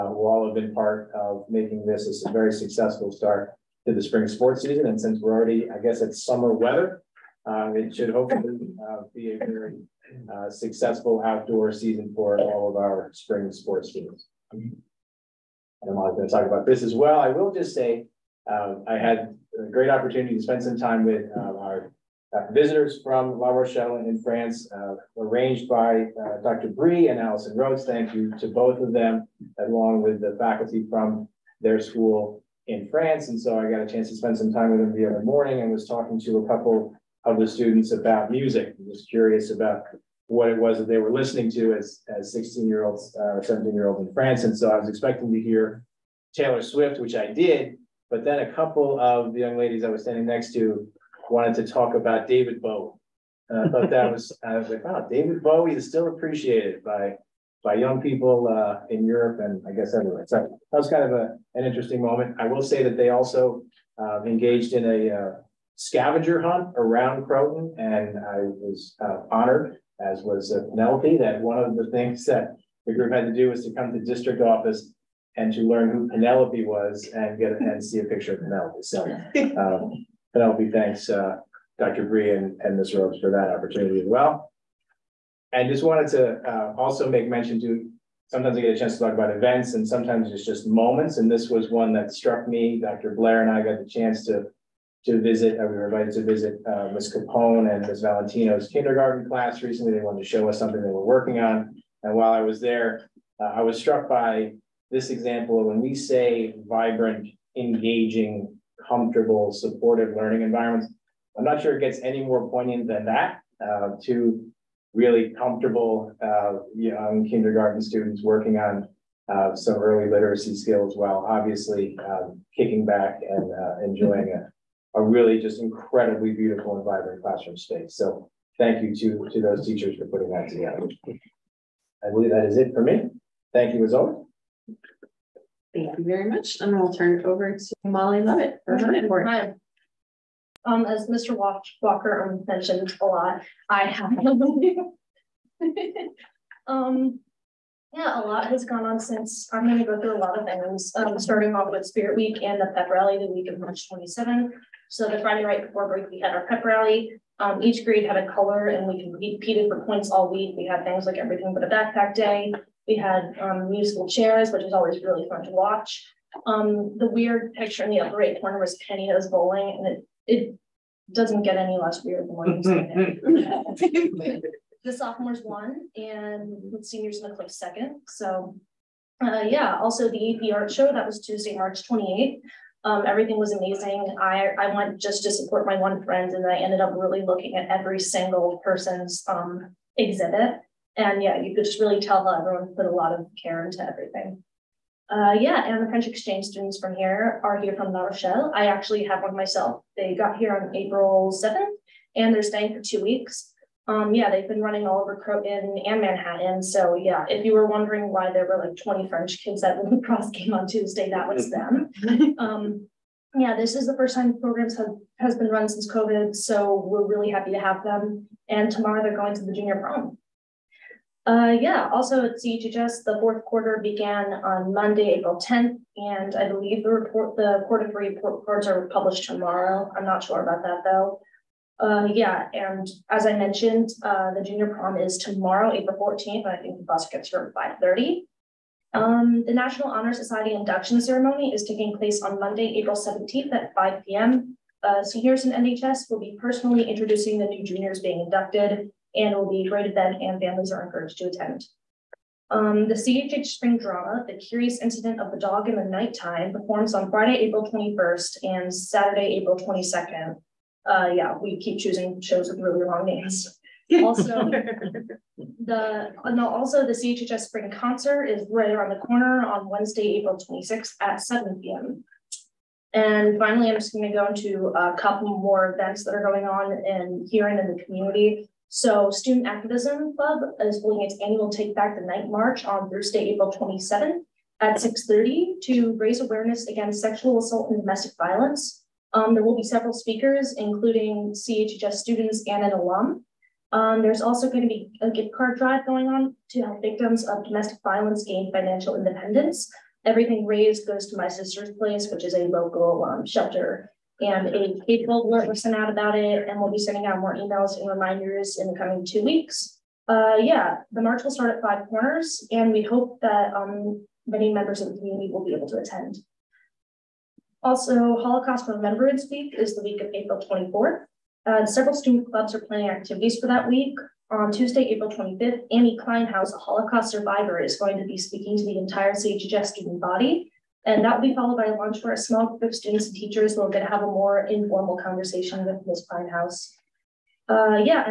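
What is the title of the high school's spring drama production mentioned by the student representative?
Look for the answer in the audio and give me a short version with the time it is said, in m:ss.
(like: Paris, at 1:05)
The Curious Incident of the Dog in the Nighttime, at 4:14.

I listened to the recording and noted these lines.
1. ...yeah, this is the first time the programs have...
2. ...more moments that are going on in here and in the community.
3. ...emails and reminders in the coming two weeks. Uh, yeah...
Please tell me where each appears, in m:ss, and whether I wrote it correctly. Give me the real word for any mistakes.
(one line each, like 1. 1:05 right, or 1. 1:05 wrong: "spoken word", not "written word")
1. 3:33 right
2. 4:35 wrong: "events", not "moments"
3. 5:07 right.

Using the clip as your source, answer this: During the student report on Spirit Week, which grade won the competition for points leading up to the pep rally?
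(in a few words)
sophomores.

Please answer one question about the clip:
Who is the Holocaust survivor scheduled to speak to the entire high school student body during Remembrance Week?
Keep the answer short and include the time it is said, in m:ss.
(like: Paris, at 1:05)
Annie Kleinhaus, at 5:25.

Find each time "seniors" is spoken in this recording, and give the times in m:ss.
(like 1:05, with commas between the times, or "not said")
2:56, 4:05.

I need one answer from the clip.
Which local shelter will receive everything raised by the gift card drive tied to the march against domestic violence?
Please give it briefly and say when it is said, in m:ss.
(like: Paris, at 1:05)
My Sister's Place, at 5:01.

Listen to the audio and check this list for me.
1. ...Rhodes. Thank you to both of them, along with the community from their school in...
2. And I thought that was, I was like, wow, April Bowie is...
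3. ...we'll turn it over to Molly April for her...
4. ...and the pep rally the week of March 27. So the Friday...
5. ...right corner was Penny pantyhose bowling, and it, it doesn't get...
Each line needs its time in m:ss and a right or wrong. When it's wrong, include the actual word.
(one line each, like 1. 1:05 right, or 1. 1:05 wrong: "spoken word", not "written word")
1. 0:27 wrong: "faculty", not "community"
2. 0:53 wrong: "David", not "April"
3. 2:16 wrong: "Lovett", not "April"
4. 2:32 right
5. 2:48 right.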